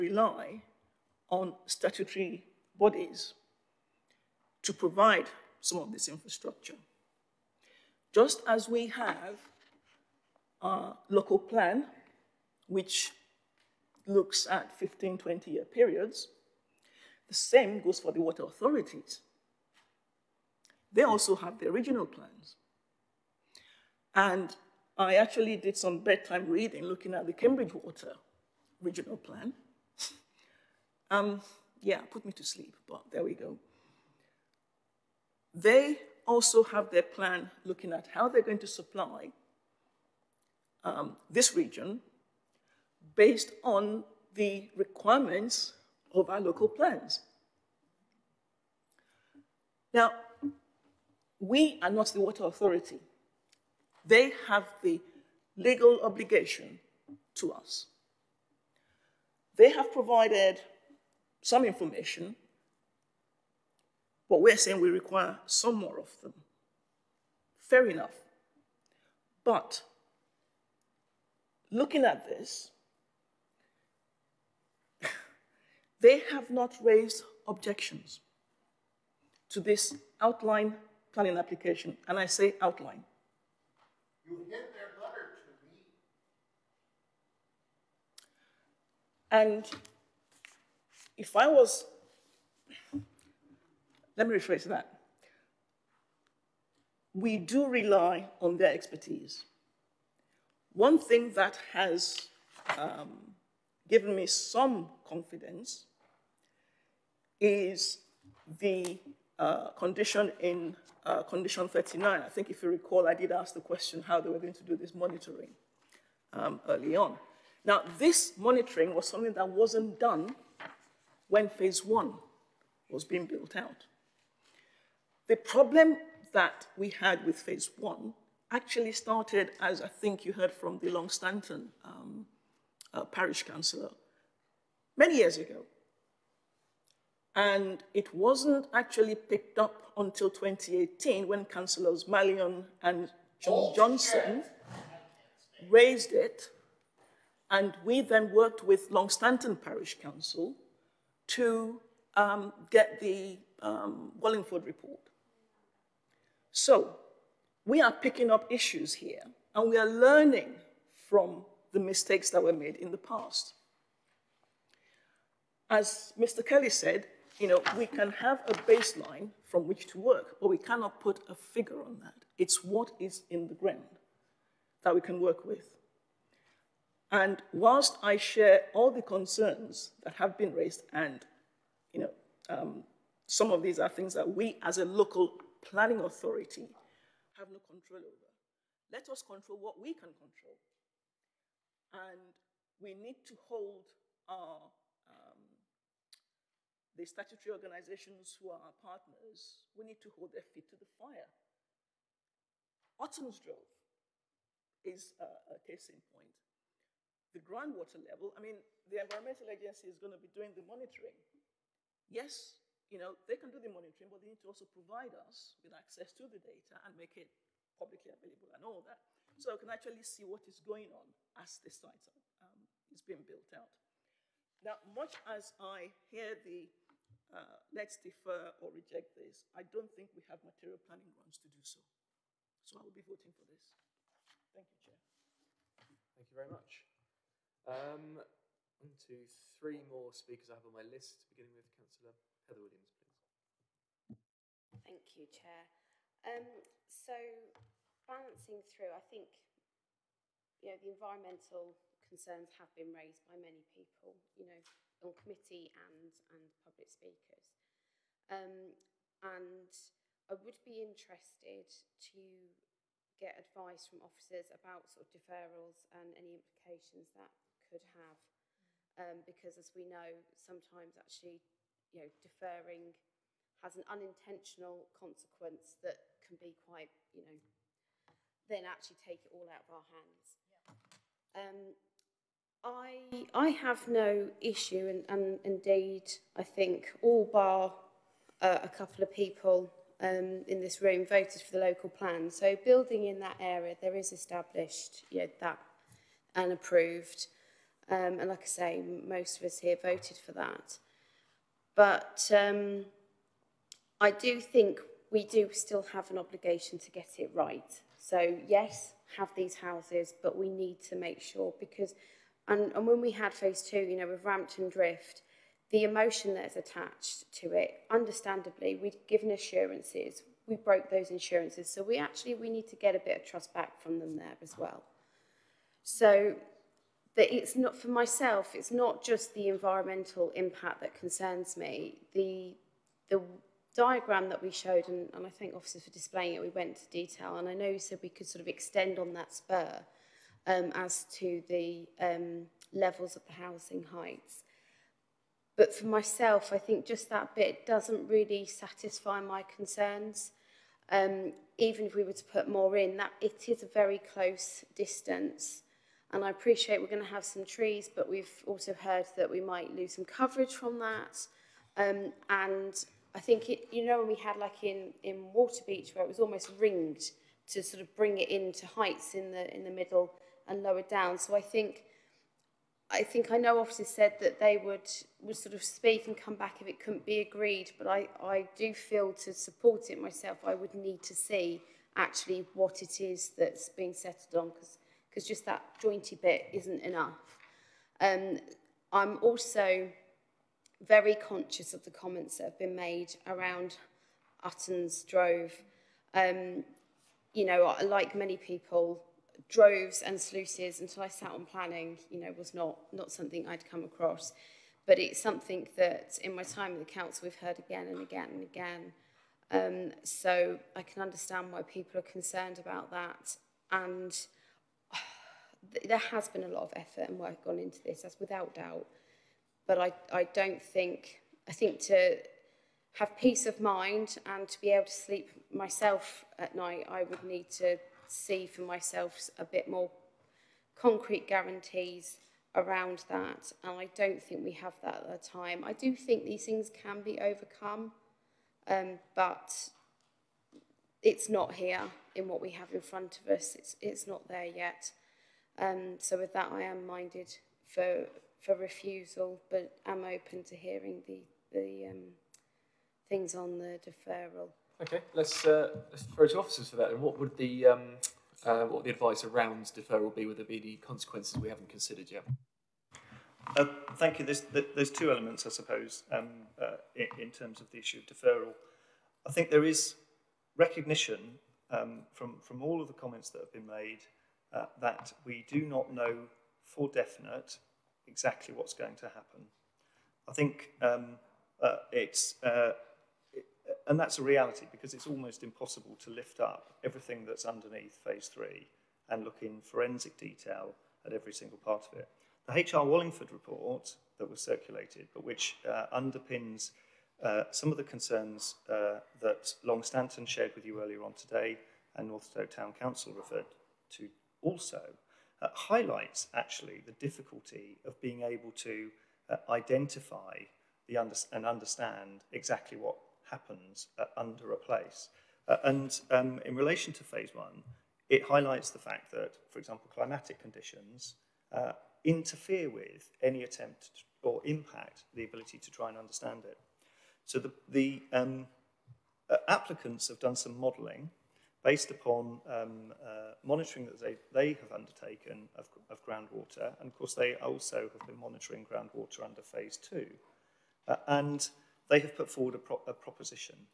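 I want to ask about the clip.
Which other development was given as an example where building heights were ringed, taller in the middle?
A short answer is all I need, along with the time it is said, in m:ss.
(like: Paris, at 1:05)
Waterbeach, at 6:05.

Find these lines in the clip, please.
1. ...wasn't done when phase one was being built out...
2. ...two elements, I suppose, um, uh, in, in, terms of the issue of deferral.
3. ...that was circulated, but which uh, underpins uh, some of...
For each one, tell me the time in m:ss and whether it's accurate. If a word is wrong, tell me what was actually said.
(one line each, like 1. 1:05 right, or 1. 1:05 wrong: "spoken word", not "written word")
1. 1:59 right
2. 7:44 right
3. 8:14 right.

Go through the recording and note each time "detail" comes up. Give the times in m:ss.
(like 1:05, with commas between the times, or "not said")
5:36, 8:10.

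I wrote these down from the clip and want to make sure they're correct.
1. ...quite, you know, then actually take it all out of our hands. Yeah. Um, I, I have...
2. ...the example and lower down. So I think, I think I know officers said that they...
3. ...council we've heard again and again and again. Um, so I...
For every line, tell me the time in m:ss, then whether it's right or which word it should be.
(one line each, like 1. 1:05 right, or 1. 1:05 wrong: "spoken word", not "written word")
1. 4:36 right
2. 6:09 wrong: "middle", not "example"
3. 6:46 right.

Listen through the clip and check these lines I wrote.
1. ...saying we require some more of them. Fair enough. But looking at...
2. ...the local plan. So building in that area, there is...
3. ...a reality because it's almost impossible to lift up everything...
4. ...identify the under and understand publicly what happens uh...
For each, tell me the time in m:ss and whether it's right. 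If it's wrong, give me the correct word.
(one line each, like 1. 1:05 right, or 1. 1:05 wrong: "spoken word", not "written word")
1. 1:04 right
2. 4:51 right
3. 8:04 right
4. 8:29 wrong: "exactly", not "publicly".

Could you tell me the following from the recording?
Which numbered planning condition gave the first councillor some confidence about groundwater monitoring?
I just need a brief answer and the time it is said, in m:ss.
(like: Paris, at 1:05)
Condition 39, at 1:51.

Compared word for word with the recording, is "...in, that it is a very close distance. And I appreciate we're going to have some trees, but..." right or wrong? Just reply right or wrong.
right.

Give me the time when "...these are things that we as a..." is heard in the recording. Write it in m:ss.
3:03.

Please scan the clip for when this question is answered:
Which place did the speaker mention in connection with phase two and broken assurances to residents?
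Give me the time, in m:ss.
5:14.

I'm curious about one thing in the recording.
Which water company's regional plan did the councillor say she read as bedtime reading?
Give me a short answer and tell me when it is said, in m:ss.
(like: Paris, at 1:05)
Cambridge Water, at 0:27.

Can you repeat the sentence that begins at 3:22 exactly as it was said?
Utton's Drove is a, a case in point.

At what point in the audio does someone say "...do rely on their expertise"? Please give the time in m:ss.
1:37.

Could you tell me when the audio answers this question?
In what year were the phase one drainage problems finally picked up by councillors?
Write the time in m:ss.
2:20.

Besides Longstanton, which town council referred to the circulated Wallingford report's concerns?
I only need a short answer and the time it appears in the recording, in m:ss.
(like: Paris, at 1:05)
Northstowe Town Council, at 8:22.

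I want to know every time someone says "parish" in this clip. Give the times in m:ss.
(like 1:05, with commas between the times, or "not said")
2:13, 2:29.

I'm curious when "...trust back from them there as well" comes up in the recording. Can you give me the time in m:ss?
5:23.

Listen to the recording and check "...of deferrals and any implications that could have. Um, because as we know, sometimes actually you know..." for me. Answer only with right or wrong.
right.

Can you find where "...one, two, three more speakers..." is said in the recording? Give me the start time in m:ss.
3:58.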